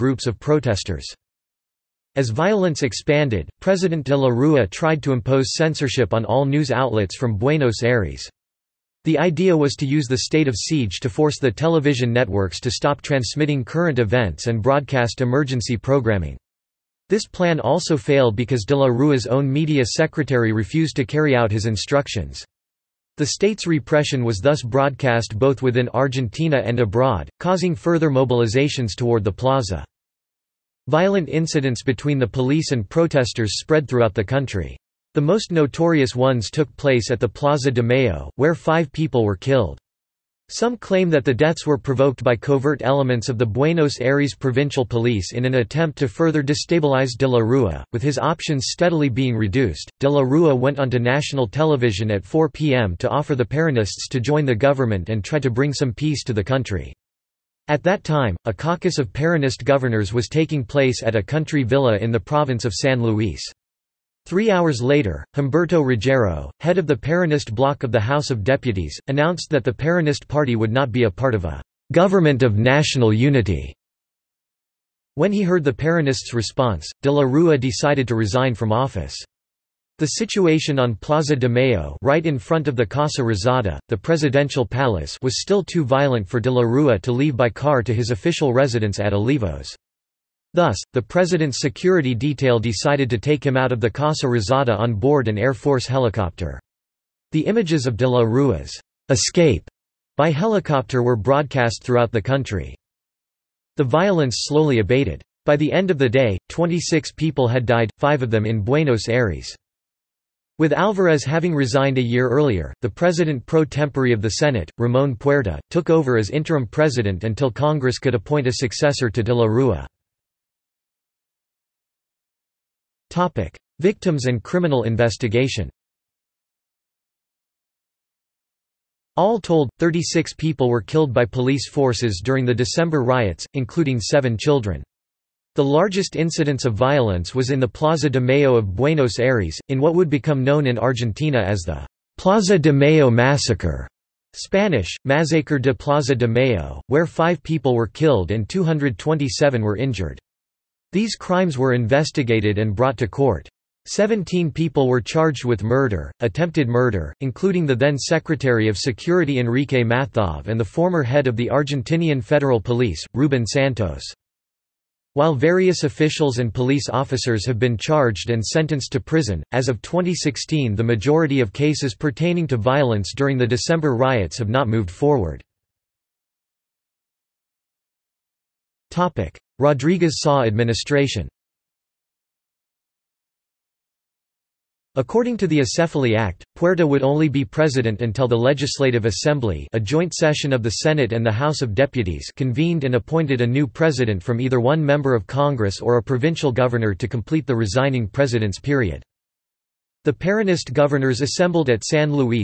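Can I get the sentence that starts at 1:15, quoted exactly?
When he heard the Peronists' response, de la Rua decided to resign from office.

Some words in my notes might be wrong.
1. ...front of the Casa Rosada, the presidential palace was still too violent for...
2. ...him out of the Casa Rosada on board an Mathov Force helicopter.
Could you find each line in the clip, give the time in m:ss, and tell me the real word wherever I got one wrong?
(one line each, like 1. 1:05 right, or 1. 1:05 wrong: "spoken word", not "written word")
1. 1:22 right
2. 1:33 wrong: "Air", not "Mathov".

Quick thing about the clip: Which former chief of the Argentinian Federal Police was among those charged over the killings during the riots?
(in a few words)
Ruben Santos.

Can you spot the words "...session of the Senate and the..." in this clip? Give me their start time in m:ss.
3:10.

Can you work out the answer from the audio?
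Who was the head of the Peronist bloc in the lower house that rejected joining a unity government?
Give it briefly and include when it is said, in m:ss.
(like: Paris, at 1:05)
Humberto Ruggiero, at 1:05.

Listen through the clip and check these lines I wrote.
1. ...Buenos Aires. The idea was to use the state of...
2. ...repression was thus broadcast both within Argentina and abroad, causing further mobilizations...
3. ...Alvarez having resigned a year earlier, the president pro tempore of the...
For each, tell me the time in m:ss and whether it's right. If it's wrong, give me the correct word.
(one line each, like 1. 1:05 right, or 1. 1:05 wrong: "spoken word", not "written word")
1. 0:07 right
2. 0:23 right
3. 1:50 right.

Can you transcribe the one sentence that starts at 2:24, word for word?
Spanish, Masacre de Plaza de Mayo, where five people were killed and 227 were injured.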